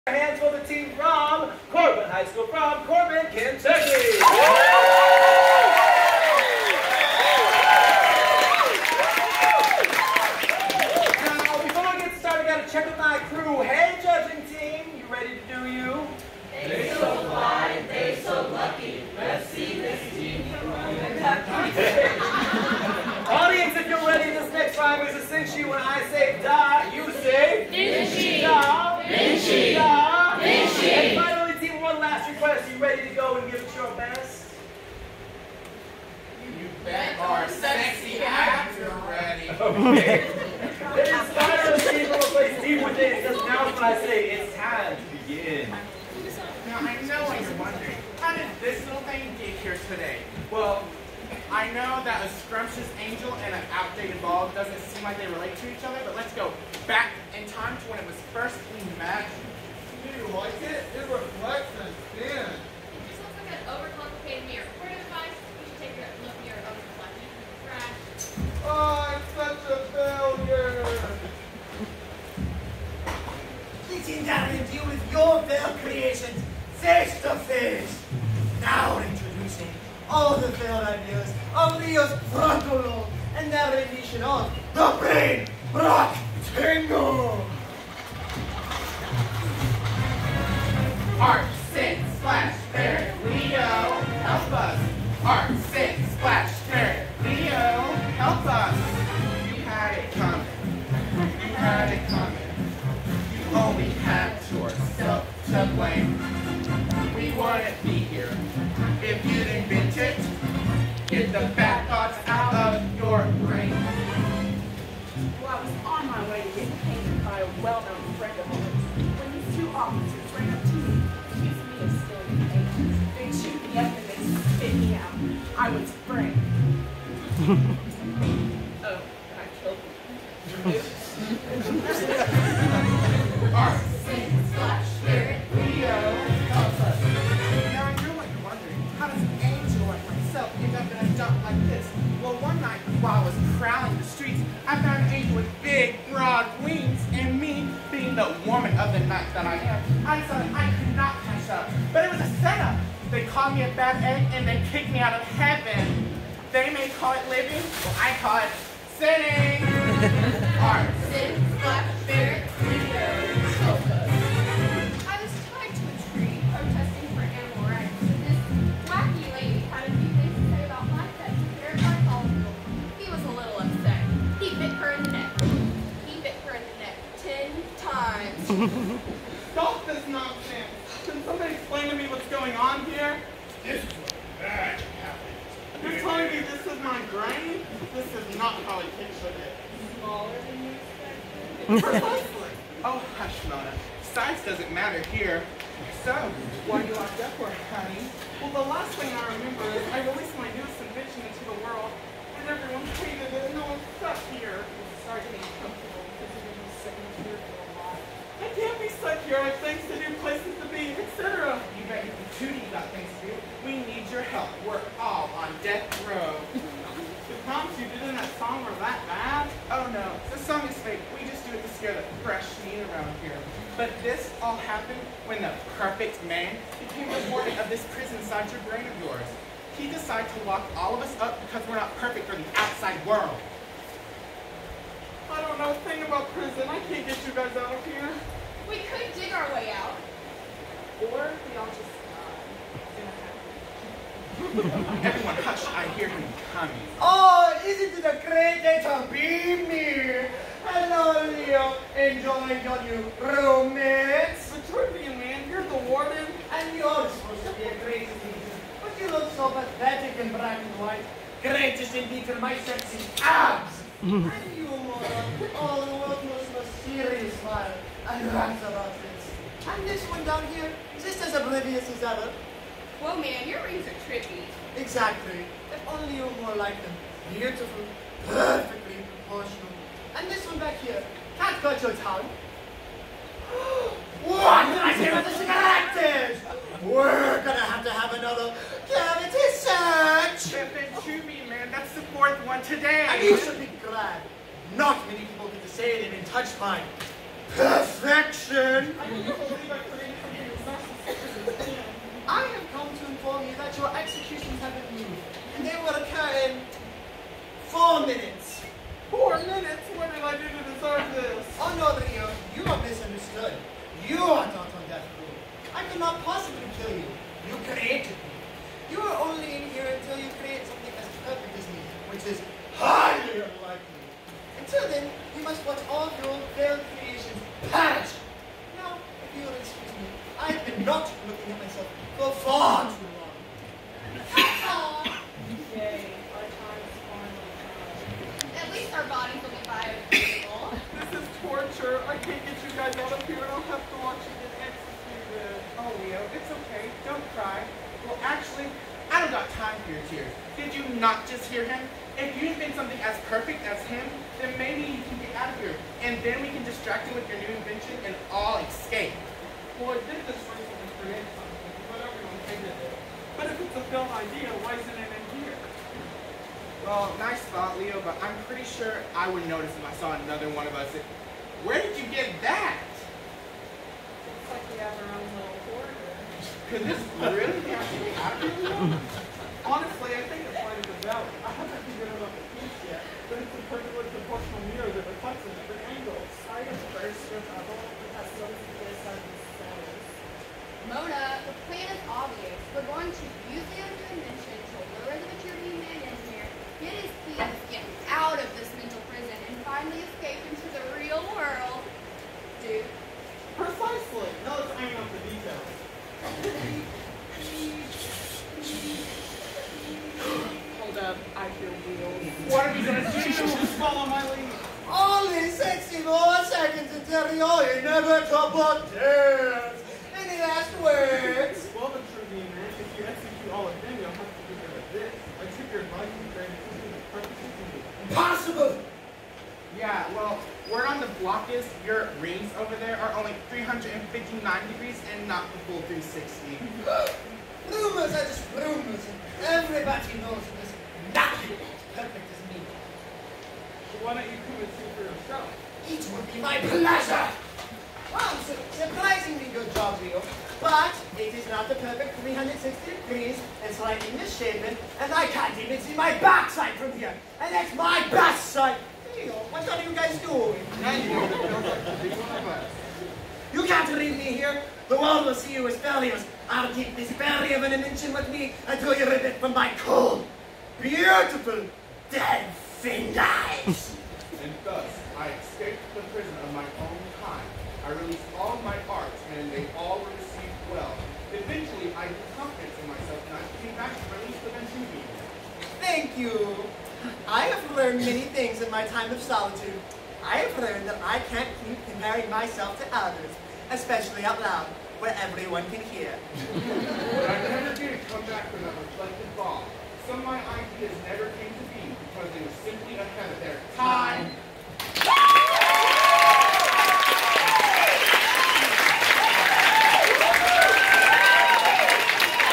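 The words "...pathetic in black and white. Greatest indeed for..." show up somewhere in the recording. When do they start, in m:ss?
4:19.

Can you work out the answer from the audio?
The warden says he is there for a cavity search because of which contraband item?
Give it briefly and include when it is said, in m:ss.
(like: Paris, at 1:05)
cigarettes, at 4:45.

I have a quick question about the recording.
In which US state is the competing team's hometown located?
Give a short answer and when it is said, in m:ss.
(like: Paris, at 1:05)
Kentucky, at 0:03.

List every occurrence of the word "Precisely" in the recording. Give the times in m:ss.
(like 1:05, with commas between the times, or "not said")
3:11, 6:43.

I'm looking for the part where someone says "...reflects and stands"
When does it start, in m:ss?
1:01.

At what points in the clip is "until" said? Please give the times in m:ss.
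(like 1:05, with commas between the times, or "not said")
5:19, 5:24, 6:56, 7:48.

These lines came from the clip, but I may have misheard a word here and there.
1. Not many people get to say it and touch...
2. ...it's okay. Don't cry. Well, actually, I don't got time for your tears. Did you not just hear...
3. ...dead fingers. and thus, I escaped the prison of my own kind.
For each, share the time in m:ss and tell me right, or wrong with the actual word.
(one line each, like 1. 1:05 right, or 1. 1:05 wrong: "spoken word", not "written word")
1. 4:54 right
2. 5:46 right
3. 7:52 right.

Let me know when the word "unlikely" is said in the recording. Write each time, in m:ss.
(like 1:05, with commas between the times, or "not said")
5:23.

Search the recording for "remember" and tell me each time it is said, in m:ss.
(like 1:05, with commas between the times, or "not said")
3:19.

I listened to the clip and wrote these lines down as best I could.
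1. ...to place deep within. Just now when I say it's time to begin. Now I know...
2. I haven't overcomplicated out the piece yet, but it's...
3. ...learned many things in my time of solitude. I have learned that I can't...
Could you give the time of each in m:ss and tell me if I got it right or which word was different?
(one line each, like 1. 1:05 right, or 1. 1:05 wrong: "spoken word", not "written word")
1. 0:42 right
2. 6:21 wrong: "figured", not "overcomplicated"
3. 8:07 right.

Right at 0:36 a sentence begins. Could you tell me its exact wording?
You bet our sexy actor ready.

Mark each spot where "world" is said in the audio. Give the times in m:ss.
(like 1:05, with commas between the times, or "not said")
3:21, 3:53, 6:41, 7:45.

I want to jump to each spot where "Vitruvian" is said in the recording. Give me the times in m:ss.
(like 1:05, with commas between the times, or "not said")
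4:14, 6:35.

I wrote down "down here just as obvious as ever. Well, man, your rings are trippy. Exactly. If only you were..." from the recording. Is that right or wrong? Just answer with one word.
wrong.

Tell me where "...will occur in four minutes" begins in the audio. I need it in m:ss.
5:05.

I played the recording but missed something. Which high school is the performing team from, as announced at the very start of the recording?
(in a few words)
Corbin High School.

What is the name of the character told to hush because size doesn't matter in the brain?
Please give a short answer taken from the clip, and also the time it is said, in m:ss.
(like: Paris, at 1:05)
Mona, at 3:13.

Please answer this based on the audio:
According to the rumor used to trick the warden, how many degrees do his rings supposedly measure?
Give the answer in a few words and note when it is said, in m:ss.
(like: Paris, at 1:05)
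359, at 7:13.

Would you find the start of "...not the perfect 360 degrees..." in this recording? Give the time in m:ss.
7:31.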